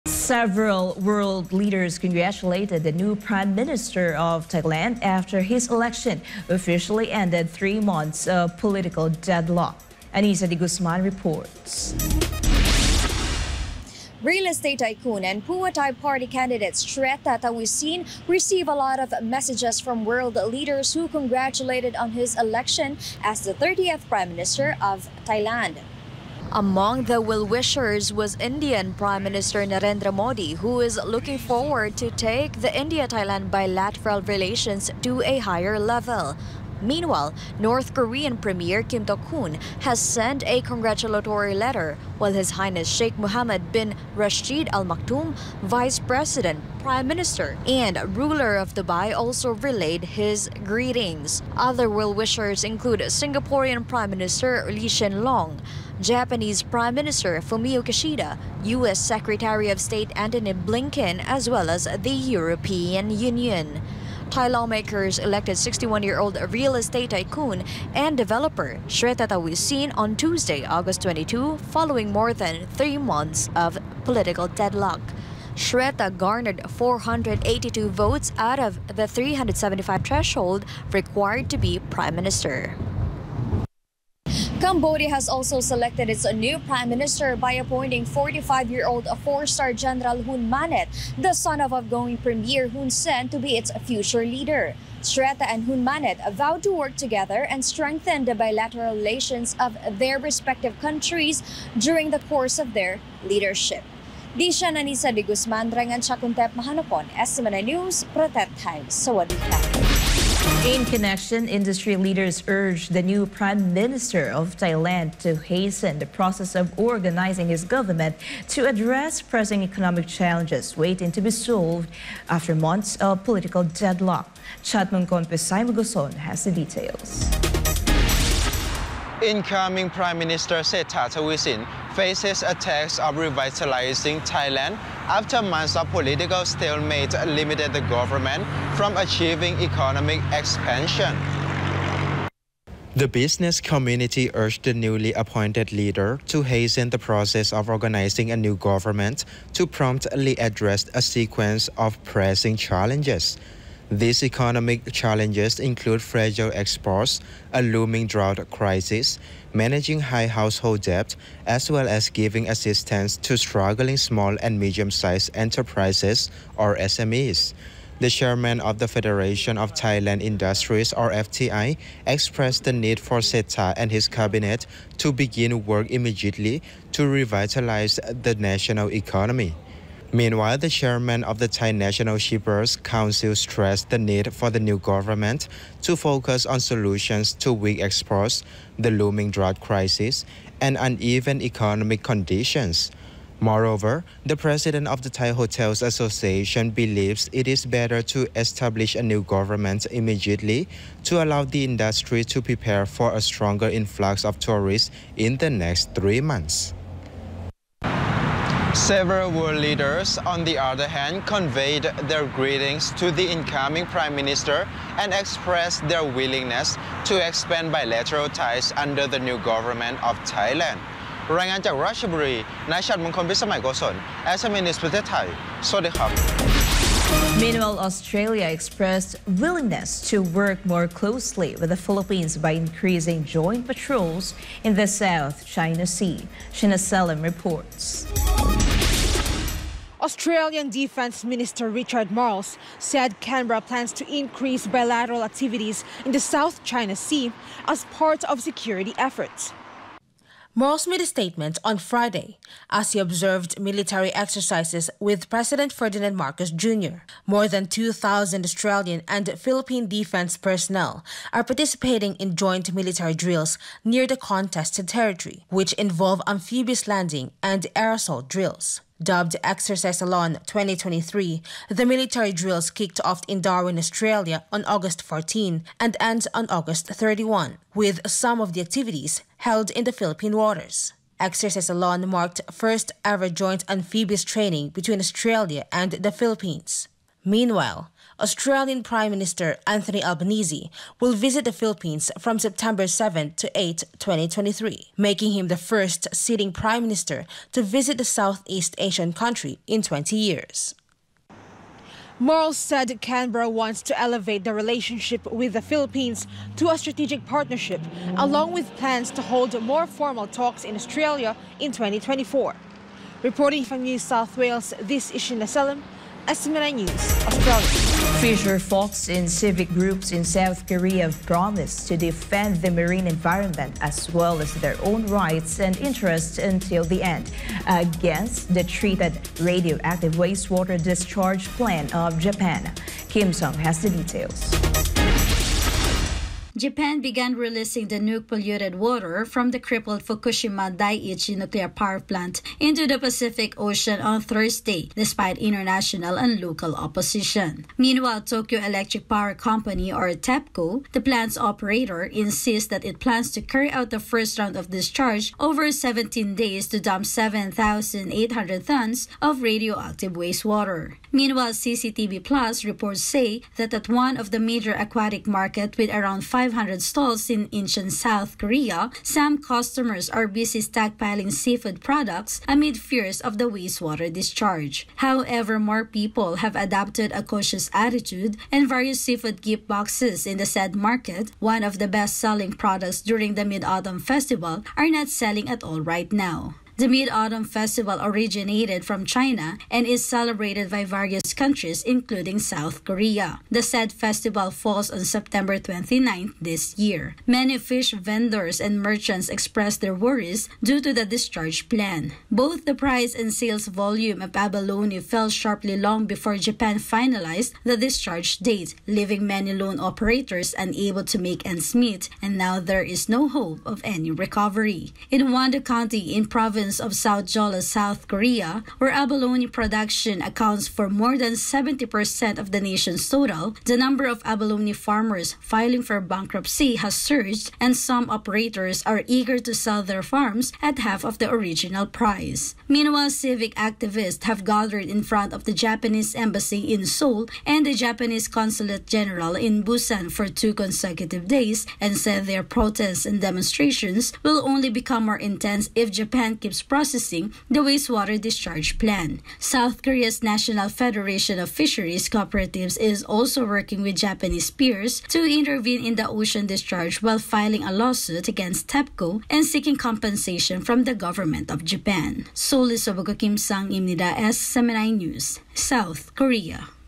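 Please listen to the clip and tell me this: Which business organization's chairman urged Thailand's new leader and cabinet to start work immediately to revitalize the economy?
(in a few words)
Federation of Thailand Industries.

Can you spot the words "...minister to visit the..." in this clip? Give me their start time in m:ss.
4:56.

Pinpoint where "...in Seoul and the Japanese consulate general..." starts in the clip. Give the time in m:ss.
7:16.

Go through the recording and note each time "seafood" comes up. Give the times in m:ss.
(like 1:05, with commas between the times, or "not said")
6:11, 6:18.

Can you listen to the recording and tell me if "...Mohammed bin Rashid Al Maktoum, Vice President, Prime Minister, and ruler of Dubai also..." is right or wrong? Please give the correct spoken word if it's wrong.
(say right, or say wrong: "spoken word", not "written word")
right.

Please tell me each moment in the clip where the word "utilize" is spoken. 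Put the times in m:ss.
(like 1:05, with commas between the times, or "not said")
not said.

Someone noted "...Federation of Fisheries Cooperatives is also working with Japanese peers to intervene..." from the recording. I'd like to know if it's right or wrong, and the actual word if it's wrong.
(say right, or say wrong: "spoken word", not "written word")
right.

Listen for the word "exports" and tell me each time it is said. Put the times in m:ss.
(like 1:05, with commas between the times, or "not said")
2:36, 3:07.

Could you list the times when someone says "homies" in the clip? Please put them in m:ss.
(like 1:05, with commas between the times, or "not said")
not said.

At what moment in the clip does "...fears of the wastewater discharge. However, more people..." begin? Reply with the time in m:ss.
6:12.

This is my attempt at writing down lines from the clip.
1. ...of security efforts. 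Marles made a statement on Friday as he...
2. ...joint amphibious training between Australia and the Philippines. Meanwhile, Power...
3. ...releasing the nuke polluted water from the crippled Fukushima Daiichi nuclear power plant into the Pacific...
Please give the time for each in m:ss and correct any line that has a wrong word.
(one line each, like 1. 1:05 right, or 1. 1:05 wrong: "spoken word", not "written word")
1. 4:08 right
2. 4:43 wrong: "Australian", not "Power"
3. 5:37 right.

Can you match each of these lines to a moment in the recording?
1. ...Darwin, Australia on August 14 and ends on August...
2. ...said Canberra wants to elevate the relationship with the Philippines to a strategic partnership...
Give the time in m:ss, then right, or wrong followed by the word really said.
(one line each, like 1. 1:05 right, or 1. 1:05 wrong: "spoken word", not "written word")
1. 4:33 right
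2. 5:02 right.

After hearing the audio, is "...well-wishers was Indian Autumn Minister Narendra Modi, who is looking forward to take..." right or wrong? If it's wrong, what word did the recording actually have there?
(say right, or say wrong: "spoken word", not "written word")
wrong: "Prime", not "Autumn".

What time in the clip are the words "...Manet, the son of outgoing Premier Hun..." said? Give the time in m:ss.
1:30.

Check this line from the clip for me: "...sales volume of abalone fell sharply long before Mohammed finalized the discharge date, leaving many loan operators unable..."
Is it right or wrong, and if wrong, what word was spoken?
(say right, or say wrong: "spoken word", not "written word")
wrong: "Japan", not "Mohammed".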